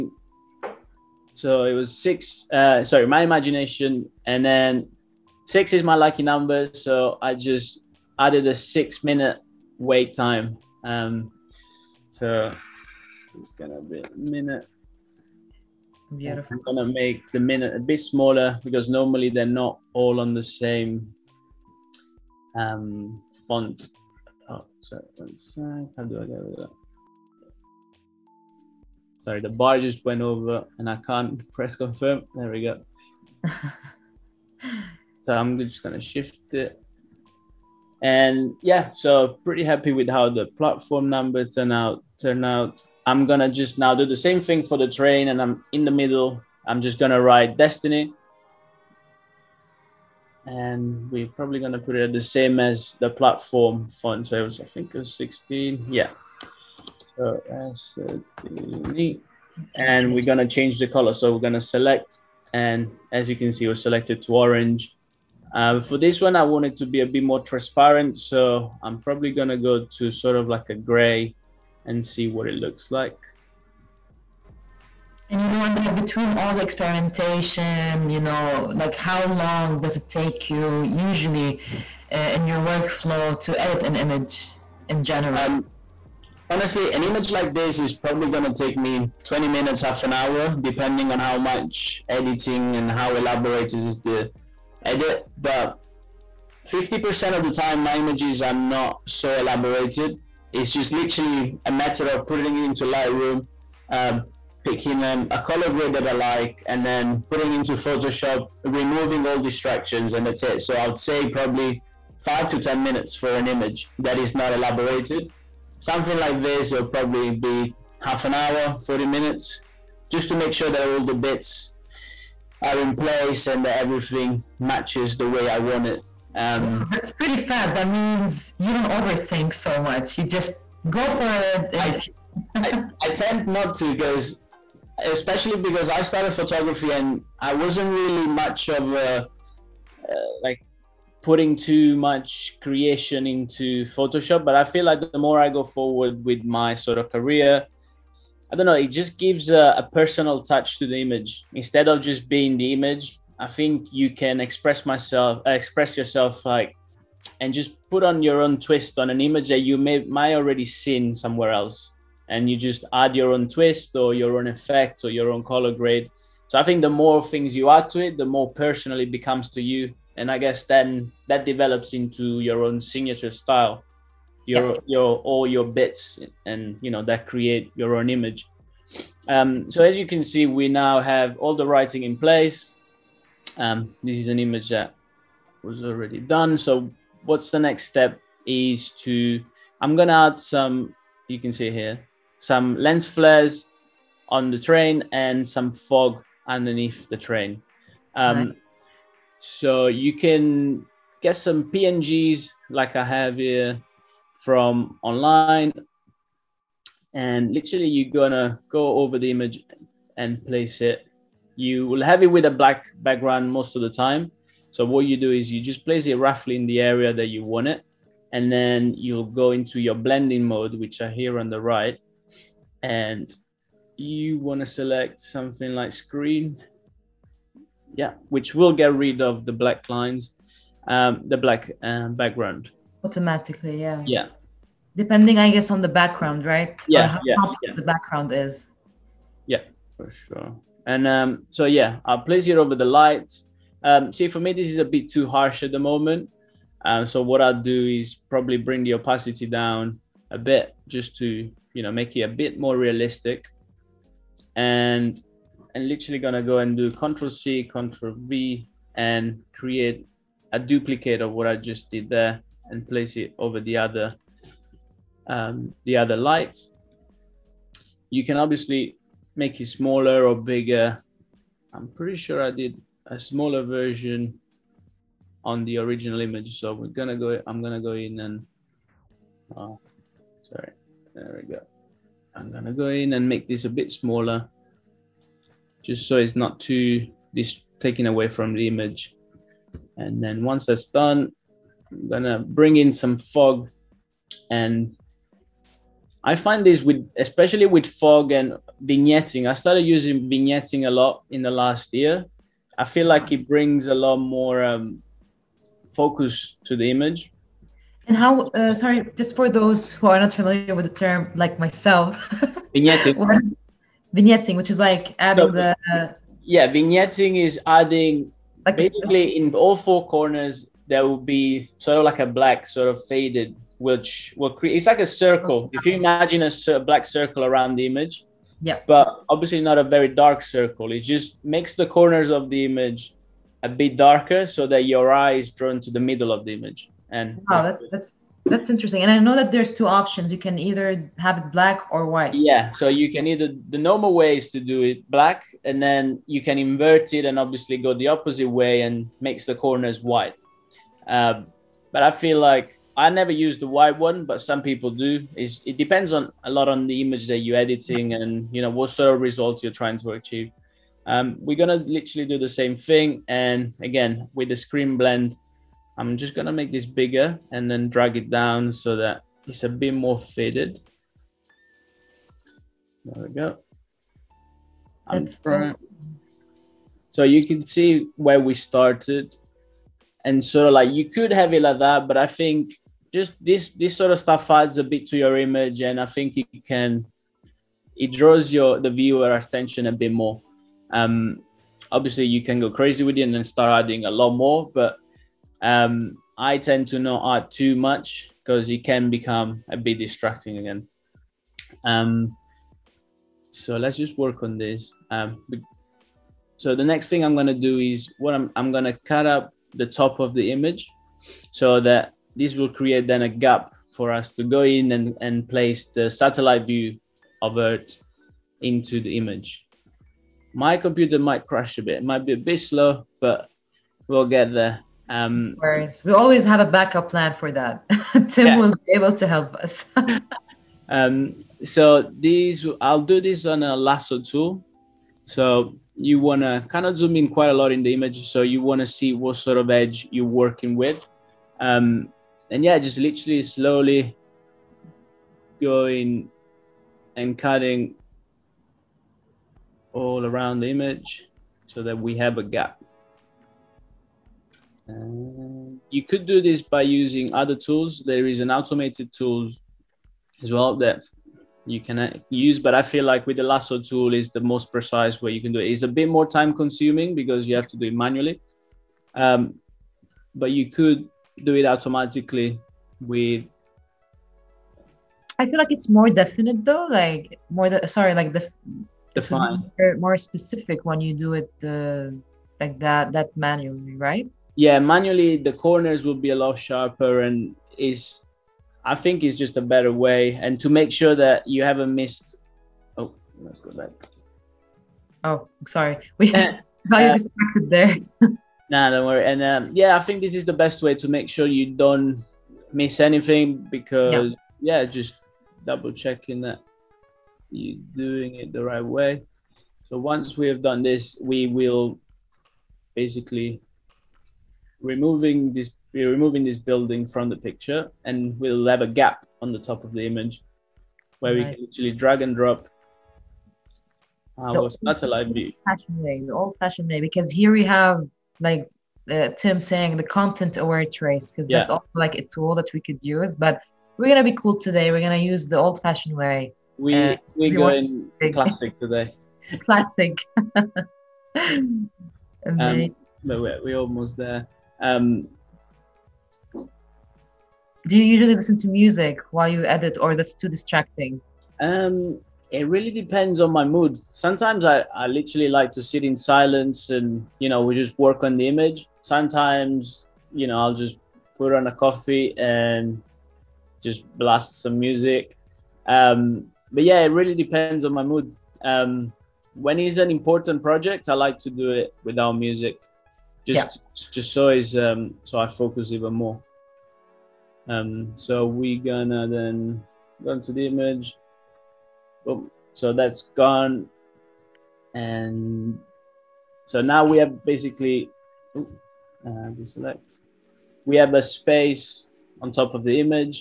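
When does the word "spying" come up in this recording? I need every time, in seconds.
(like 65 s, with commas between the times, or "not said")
not said.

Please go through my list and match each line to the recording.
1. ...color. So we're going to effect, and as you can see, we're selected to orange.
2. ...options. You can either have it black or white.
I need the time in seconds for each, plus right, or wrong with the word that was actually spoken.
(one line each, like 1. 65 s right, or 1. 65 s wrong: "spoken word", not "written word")
1. 60 s wrong: "select", not "effect"
2. 339 s right.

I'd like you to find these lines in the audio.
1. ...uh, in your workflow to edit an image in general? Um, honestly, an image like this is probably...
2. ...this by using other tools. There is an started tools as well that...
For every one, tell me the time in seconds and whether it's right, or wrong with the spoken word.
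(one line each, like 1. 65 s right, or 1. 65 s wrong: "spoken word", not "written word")
1. 82 s right
2. 456 s wrong: "automated", not "started".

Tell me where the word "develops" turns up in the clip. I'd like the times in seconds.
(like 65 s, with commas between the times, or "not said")
171 s.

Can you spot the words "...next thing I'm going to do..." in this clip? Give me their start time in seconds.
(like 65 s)
406 s.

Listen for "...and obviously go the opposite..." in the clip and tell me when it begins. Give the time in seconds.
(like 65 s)
347 s.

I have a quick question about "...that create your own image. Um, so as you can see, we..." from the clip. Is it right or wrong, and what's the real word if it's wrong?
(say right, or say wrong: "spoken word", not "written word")
right.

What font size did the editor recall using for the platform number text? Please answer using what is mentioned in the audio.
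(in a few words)
16.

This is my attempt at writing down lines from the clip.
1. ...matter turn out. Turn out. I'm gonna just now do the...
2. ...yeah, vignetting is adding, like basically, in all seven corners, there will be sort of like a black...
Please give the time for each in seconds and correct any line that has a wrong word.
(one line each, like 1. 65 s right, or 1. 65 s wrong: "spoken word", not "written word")
1. 41 s wrong: "number", not "matter"
2. 316 s wrong: "four", not "seven".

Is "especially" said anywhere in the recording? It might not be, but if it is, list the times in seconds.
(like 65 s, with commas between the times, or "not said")
135 s, 297 s.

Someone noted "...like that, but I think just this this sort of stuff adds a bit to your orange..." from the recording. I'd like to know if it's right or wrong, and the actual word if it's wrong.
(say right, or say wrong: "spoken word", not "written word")
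wrong: "image", not "orange".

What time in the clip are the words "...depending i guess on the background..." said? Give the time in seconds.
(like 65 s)
234 s.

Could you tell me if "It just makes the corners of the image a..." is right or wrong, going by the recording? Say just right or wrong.
right.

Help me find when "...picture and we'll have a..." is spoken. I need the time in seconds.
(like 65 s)
517 s.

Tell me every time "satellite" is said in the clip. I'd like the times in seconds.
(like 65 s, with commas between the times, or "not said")
416 s, 524 s.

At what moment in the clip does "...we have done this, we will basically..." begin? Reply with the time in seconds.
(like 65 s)
510 s.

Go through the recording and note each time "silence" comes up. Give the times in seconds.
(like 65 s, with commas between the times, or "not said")
556 s.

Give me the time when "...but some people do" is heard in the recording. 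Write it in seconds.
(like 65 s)
354 s.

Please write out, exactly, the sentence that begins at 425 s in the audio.
Um, Whereas we always have a backup plan for that.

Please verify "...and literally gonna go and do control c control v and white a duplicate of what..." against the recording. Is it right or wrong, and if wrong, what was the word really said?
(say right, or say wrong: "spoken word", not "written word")
wrong: "create", not "white".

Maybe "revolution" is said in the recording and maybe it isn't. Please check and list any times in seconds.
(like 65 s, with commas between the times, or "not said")
not said.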